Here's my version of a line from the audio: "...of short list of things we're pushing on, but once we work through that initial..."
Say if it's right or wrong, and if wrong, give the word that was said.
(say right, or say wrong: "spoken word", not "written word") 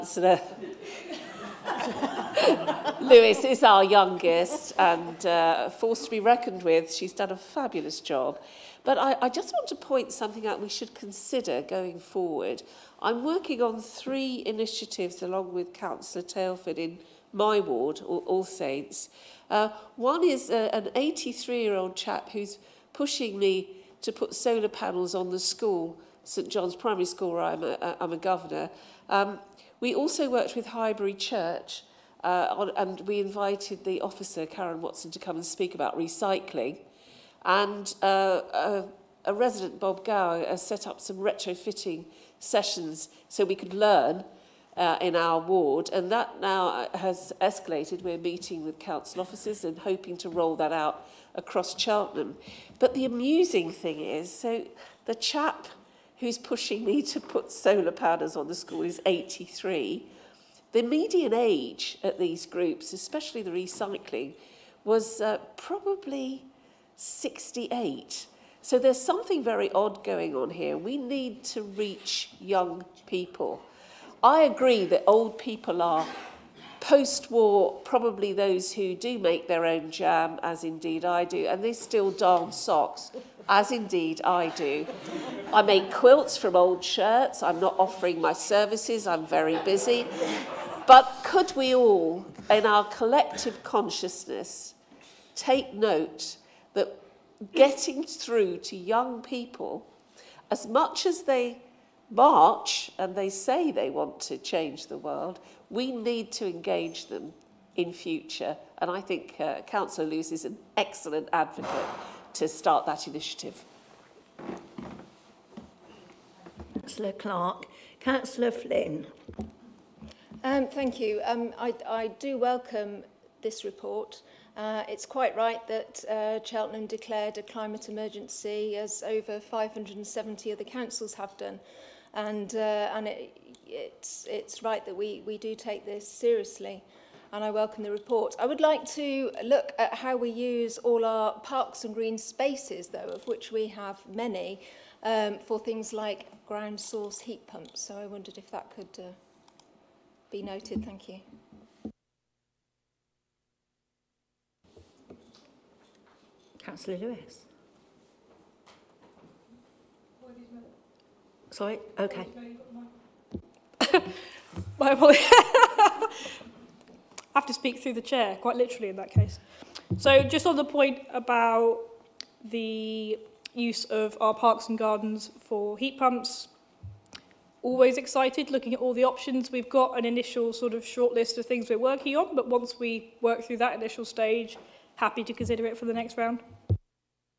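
wrong: "working", not "pushing".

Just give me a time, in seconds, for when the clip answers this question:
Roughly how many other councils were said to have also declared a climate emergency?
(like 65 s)
129 s.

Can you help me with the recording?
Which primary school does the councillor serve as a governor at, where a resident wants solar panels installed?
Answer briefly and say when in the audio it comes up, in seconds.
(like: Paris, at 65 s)
St John's Primary School, at 26 s.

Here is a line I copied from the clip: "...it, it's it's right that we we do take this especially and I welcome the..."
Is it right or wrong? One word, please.
wrong.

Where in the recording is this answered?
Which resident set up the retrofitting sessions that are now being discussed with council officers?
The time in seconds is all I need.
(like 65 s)
39 s.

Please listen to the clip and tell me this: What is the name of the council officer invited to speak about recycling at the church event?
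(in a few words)
Karen Watson.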